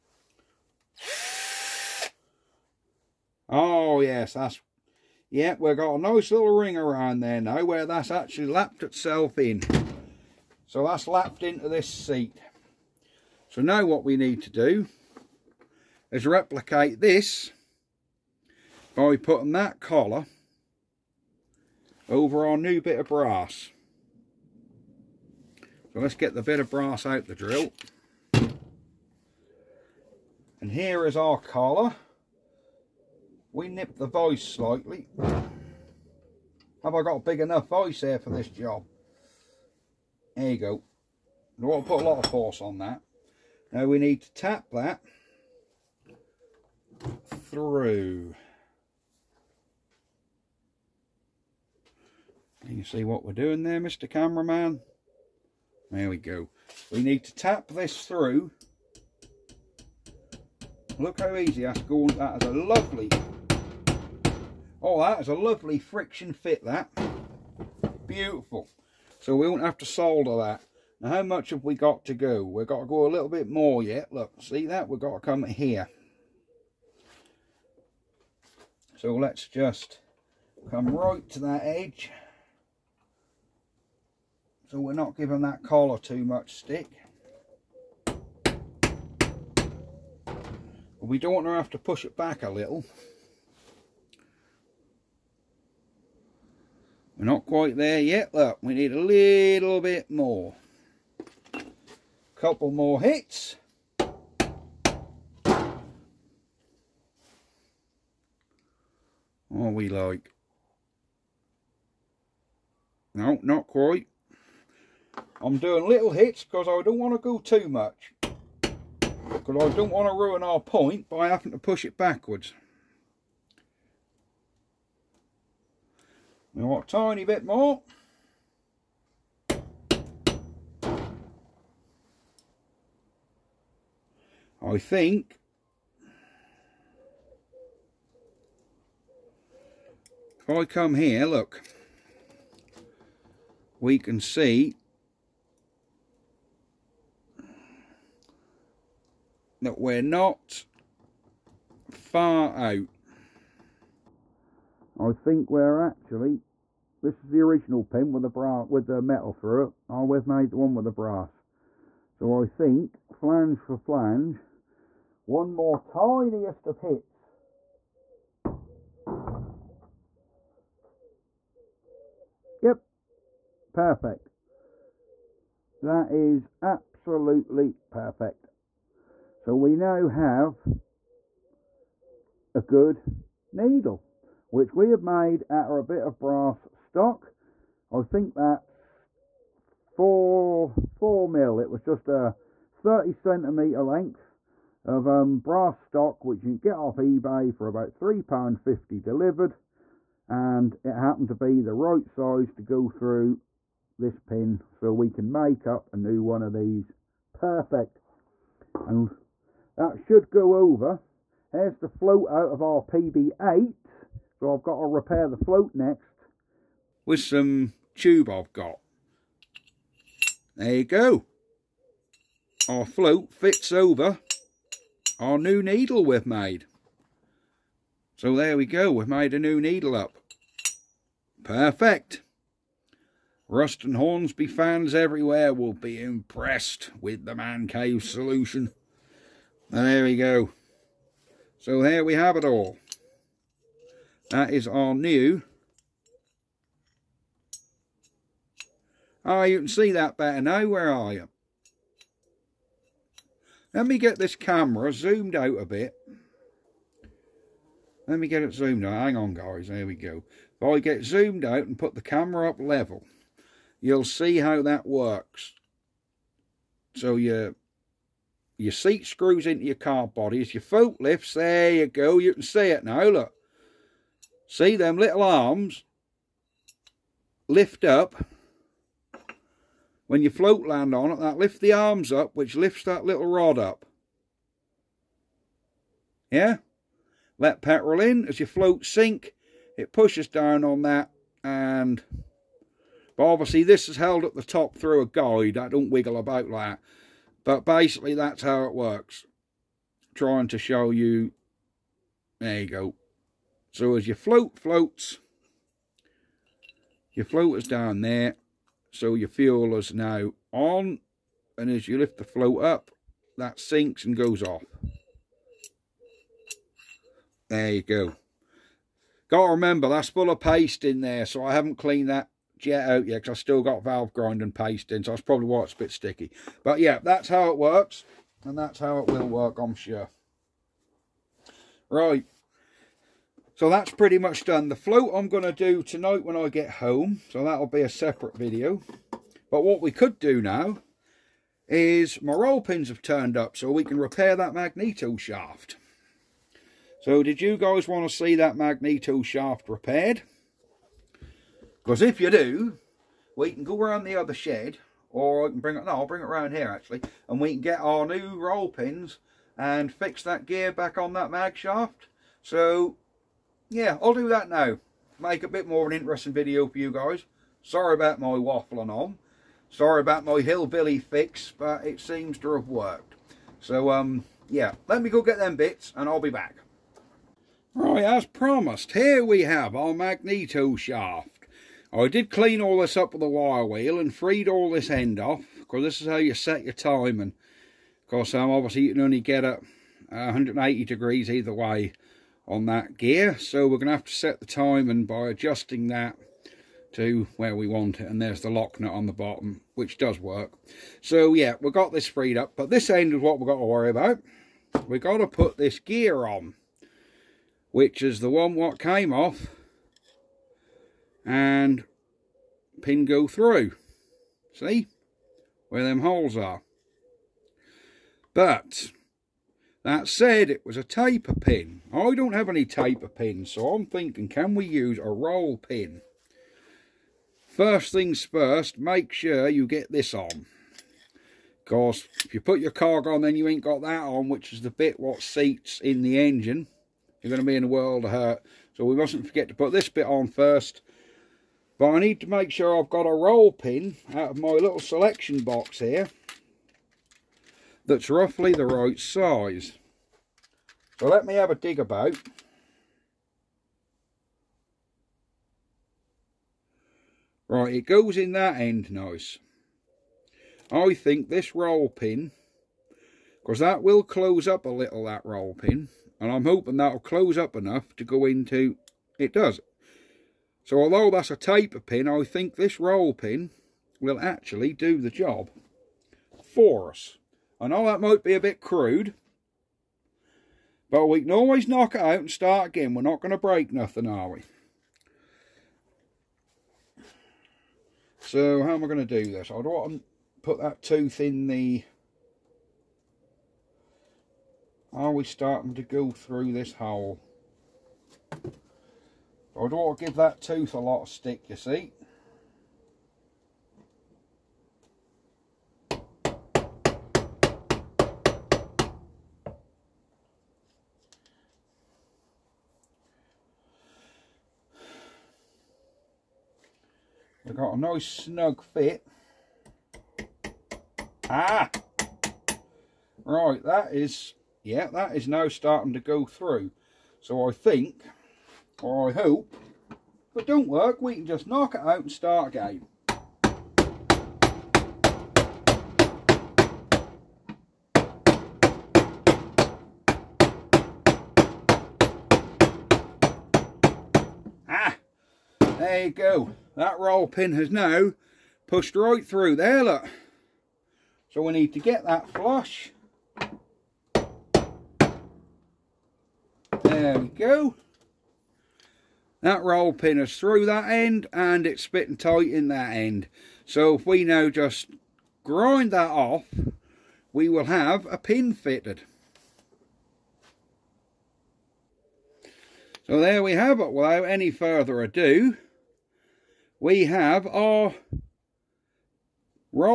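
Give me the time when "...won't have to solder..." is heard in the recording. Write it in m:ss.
1:09.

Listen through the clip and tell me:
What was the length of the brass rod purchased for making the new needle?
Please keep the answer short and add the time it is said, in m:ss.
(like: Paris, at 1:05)
30 centimeters, at 3:12.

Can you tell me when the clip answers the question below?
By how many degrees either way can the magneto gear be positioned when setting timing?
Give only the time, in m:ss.
6:30.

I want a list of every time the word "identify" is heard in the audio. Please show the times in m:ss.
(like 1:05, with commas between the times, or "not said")
not said.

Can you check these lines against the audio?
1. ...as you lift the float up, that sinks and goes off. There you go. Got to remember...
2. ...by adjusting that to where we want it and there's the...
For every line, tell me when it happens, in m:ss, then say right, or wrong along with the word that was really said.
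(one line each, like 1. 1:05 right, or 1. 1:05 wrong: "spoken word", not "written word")
1. 5:11 right
2. 6:35 right.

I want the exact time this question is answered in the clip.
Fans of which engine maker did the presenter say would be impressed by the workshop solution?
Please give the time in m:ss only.
3:53.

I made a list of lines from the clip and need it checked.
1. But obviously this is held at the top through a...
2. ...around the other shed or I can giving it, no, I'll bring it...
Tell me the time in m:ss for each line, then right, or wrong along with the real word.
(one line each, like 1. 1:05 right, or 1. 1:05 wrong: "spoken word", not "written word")
1. 4:53 right
2. 5:53 wrong: "bring", not "giving".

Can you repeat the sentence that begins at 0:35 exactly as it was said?
Have I got a big enough voice here for this job?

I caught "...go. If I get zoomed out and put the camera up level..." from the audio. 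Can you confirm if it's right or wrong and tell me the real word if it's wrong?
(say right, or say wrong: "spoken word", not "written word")
right.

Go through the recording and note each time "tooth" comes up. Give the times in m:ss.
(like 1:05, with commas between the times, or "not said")
8:10, 8:20.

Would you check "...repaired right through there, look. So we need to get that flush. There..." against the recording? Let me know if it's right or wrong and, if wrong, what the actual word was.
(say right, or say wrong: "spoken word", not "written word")
wrong: "pushed", not "repaired".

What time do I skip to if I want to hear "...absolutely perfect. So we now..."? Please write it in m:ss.
2:56.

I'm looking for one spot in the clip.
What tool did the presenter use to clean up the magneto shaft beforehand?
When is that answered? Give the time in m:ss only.
6:23.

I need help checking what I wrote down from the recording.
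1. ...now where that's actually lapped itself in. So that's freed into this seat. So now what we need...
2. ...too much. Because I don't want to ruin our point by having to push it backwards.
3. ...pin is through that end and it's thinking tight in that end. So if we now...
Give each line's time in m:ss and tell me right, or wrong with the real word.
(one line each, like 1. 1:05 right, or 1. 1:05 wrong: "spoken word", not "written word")
1. 0:07 wrong: "lapped", not "freed"
2. 1:57 right
3. 9:19 wrong: "spitting", not "thinking".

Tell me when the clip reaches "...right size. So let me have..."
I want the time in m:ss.
7:28.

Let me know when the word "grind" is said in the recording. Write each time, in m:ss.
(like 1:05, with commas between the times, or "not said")
5:24, 9:25.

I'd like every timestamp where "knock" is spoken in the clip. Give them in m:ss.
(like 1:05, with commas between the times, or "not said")
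8:01, 8:51.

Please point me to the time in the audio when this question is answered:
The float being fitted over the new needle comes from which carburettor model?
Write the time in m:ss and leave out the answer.
3:32.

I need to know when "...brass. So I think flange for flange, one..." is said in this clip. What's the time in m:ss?
2:40.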